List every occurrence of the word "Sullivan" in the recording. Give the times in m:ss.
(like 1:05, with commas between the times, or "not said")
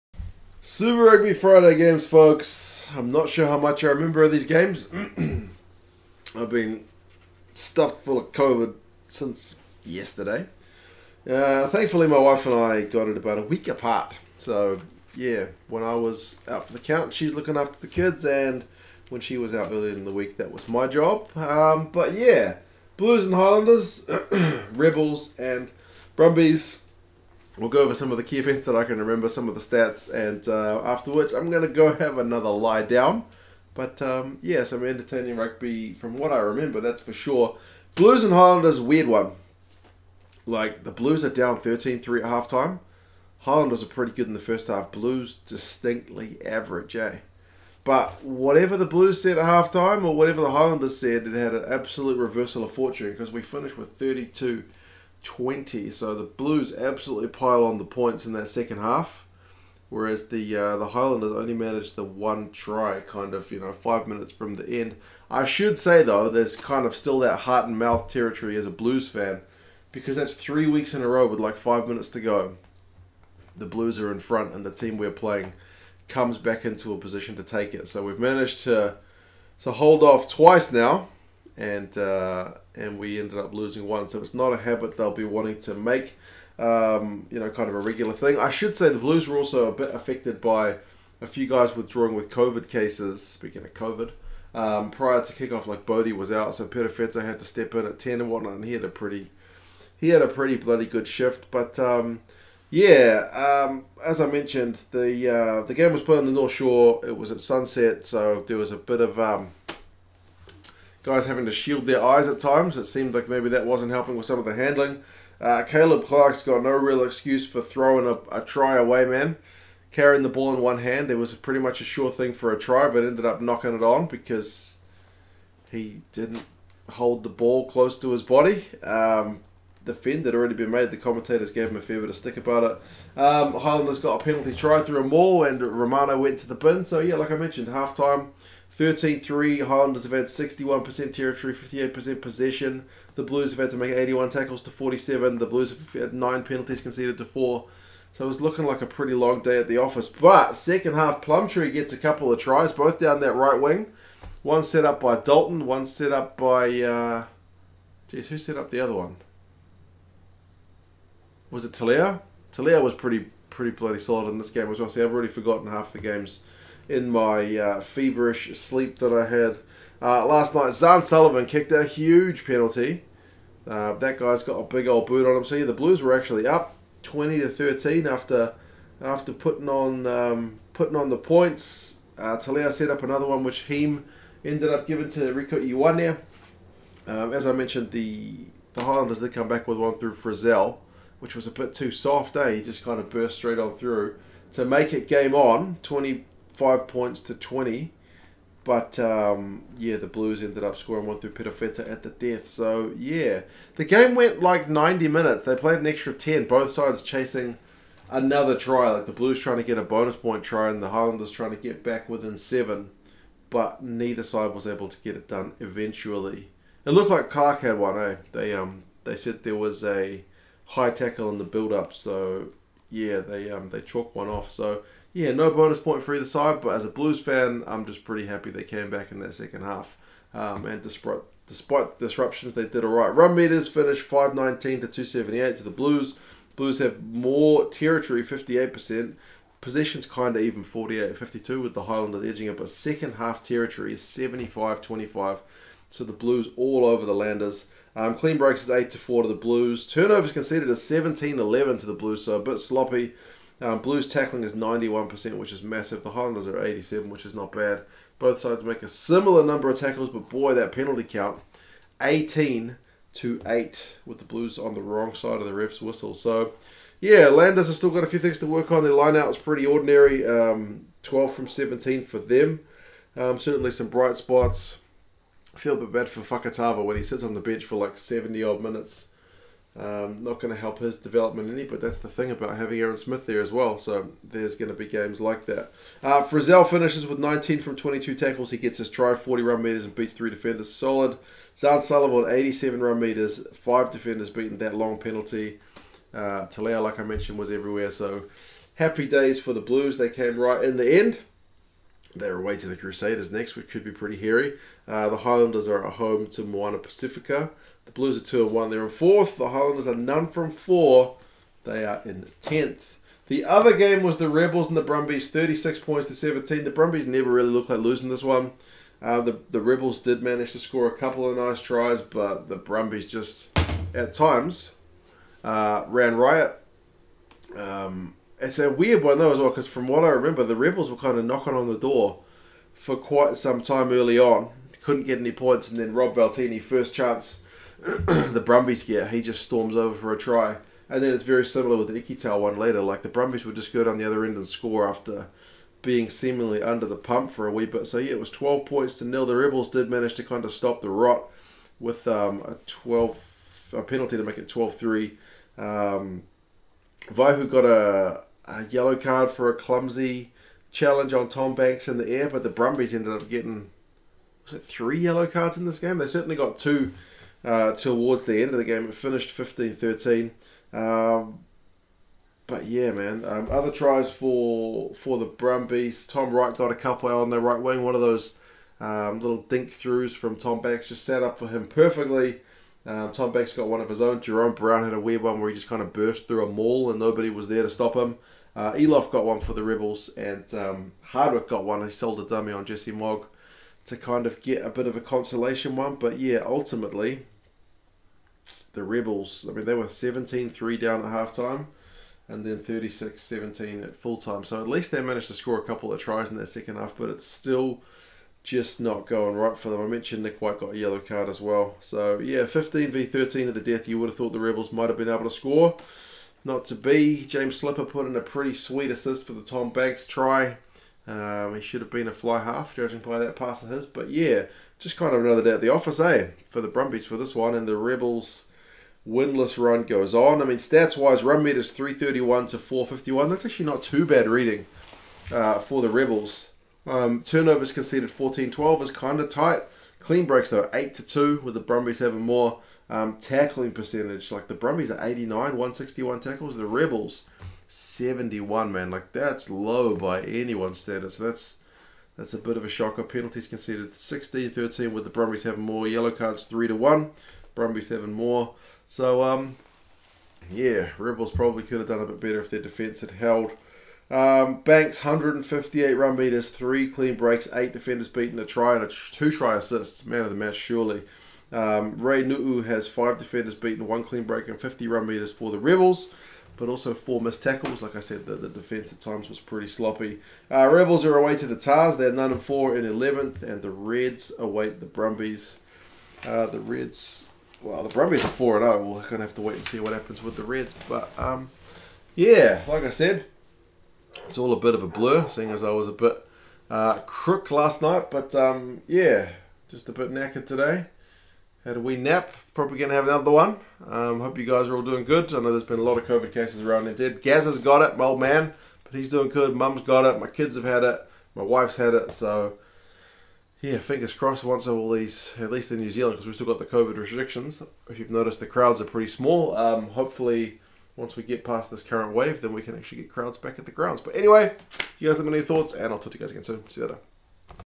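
2:51, 4:51.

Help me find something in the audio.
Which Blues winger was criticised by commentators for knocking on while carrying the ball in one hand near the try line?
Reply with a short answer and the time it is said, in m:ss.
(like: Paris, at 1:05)
Caleb Clarke, at 1:55.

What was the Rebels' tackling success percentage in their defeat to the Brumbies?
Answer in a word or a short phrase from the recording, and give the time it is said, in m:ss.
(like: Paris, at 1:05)
71%, at 7:26.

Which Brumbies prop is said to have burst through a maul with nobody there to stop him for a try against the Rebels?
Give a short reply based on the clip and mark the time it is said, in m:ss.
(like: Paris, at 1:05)
Jerome Brown, at 6:24.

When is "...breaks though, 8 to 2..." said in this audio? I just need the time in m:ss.
7:20.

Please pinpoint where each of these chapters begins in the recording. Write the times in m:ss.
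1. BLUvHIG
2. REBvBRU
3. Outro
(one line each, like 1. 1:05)
1. 0:40
2. 5:12
3. 8:13.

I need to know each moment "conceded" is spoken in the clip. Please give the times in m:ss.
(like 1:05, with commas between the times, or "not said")
2:26, 4:10, 7:17, 7:33.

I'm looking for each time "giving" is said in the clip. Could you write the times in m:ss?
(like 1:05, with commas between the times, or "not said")
3:04.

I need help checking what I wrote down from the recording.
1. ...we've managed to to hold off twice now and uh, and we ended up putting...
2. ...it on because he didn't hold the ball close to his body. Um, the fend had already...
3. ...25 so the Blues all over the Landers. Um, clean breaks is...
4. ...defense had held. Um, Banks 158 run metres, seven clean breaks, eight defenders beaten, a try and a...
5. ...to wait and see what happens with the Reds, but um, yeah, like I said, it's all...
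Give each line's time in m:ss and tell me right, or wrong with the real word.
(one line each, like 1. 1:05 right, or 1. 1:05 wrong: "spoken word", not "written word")
1. 1:18 wrong: "losing", not "putting"
2. 2:03 right
3. 4:04 right
4. 7:42 wrong: "three", not "seven"
5. 8:09 right.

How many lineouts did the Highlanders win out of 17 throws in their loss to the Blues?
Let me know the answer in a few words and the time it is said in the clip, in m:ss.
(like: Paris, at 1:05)
12, at 4:31.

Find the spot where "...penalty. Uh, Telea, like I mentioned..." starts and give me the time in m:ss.
4:54.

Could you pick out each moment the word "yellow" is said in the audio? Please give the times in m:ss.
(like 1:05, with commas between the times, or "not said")
5:58, 6:04, 6:50, 7:35.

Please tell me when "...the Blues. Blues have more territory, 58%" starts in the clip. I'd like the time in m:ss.
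3:55.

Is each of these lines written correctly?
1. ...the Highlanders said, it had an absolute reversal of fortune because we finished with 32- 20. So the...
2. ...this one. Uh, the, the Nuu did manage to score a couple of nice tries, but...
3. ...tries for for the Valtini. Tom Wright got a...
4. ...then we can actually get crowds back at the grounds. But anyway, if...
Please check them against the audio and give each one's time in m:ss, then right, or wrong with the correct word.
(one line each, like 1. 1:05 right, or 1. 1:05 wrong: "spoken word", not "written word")
1. 0:50 right
2. 5:18 wrong: "Rebels", not "Nuu"
3. 6:13 wrong: "Brumbies", not "Valtini"
4. 8:42 right.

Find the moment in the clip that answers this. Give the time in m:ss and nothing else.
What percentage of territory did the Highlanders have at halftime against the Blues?
2:20.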